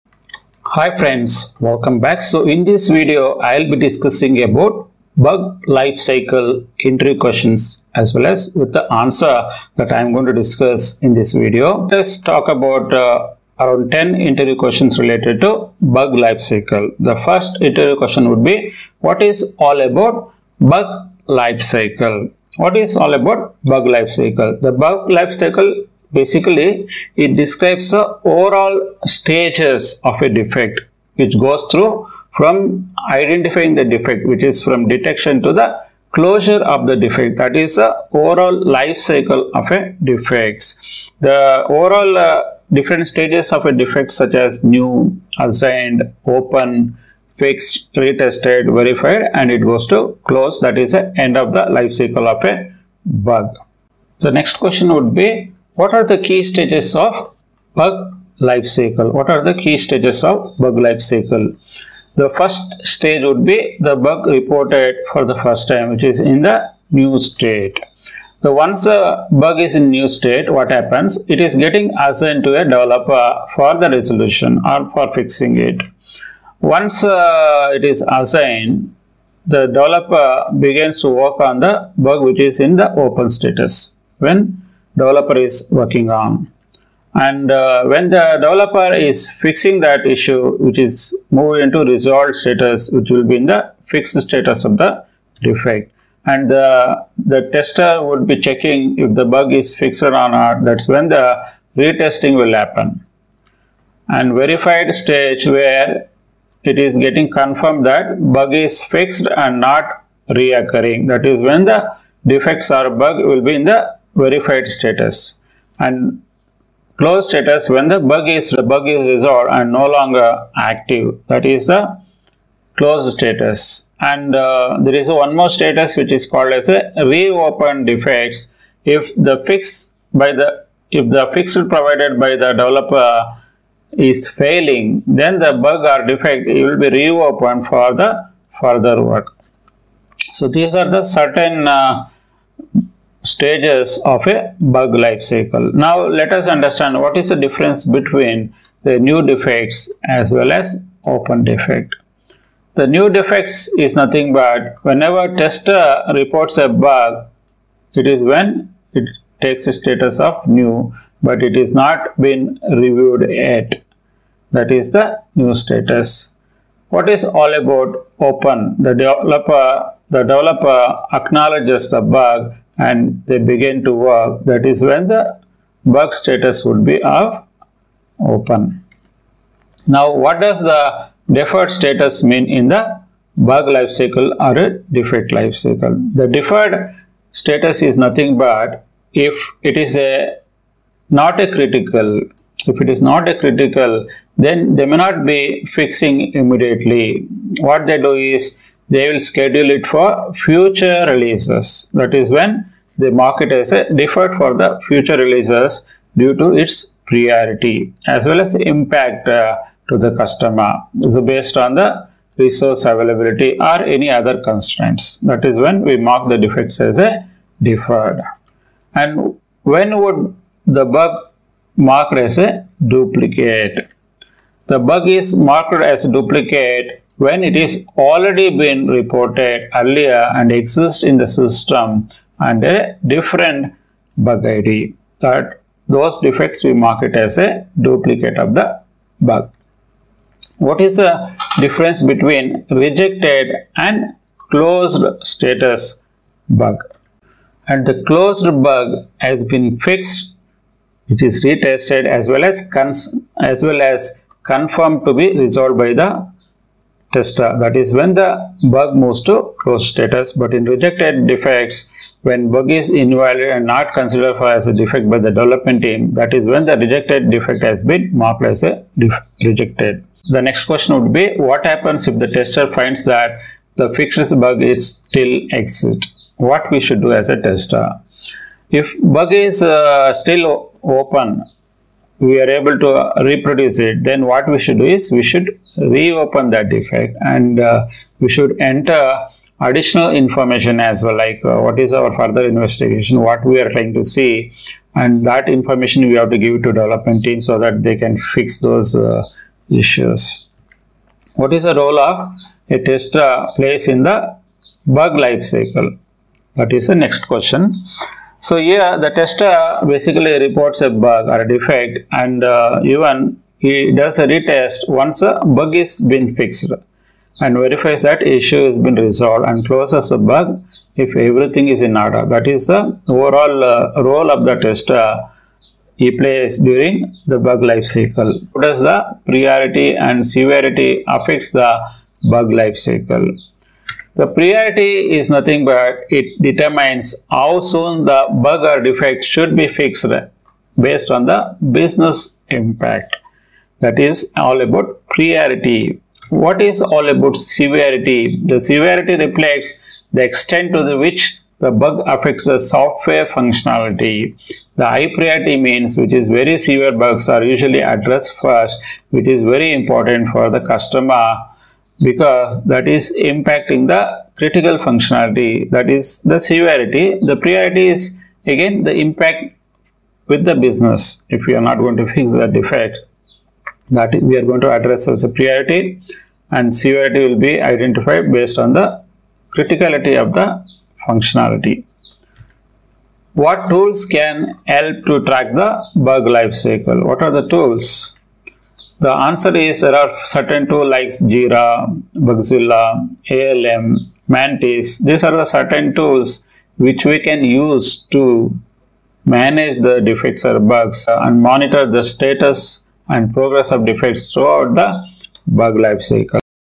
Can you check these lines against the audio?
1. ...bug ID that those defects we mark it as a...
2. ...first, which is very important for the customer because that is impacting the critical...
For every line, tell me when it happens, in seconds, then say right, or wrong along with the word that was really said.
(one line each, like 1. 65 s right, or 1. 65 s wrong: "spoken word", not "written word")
1. 234 s right
2. 358 s right.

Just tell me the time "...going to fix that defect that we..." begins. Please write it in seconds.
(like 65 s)
371 s.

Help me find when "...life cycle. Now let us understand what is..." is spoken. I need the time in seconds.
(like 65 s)
144 s.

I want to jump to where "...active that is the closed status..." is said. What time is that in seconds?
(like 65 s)
120 s.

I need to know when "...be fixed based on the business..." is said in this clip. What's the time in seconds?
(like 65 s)
339 s.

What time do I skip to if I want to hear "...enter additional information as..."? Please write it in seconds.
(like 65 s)
288 s.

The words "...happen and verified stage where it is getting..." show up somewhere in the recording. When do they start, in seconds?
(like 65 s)
102 s.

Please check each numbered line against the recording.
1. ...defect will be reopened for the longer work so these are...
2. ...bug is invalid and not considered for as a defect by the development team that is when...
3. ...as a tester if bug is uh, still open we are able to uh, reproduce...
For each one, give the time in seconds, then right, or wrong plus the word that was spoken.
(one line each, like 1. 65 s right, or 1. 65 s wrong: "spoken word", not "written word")
1. 136 s wrong: "further", not "longer"
2. 262 s right
3. 277 s right.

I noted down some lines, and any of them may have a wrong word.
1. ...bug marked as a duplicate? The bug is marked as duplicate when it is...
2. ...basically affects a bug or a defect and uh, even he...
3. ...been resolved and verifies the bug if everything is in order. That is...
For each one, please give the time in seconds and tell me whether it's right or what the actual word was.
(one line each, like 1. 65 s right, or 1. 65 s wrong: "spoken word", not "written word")
1. 220 s right
2. 309 s wrong: "reports", not "affects"
3. 318 s wrong: "closes", not "verifies".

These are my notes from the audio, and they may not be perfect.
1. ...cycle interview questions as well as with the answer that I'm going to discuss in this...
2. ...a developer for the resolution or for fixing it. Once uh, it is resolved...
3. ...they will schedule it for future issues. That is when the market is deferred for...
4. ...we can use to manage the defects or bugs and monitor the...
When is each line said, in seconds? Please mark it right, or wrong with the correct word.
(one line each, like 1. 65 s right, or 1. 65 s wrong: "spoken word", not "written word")
1. 5 s right
2. 72 s wrong: "assigned", not "resolved"
3. 198 s wrong: "releases", not "issues"
4. 397 s right.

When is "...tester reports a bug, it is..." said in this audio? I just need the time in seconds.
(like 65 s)
155 s.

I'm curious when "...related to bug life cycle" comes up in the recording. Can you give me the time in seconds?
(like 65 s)
14 s.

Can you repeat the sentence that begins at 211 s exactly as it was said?
So based on the resource availability or any other constraints.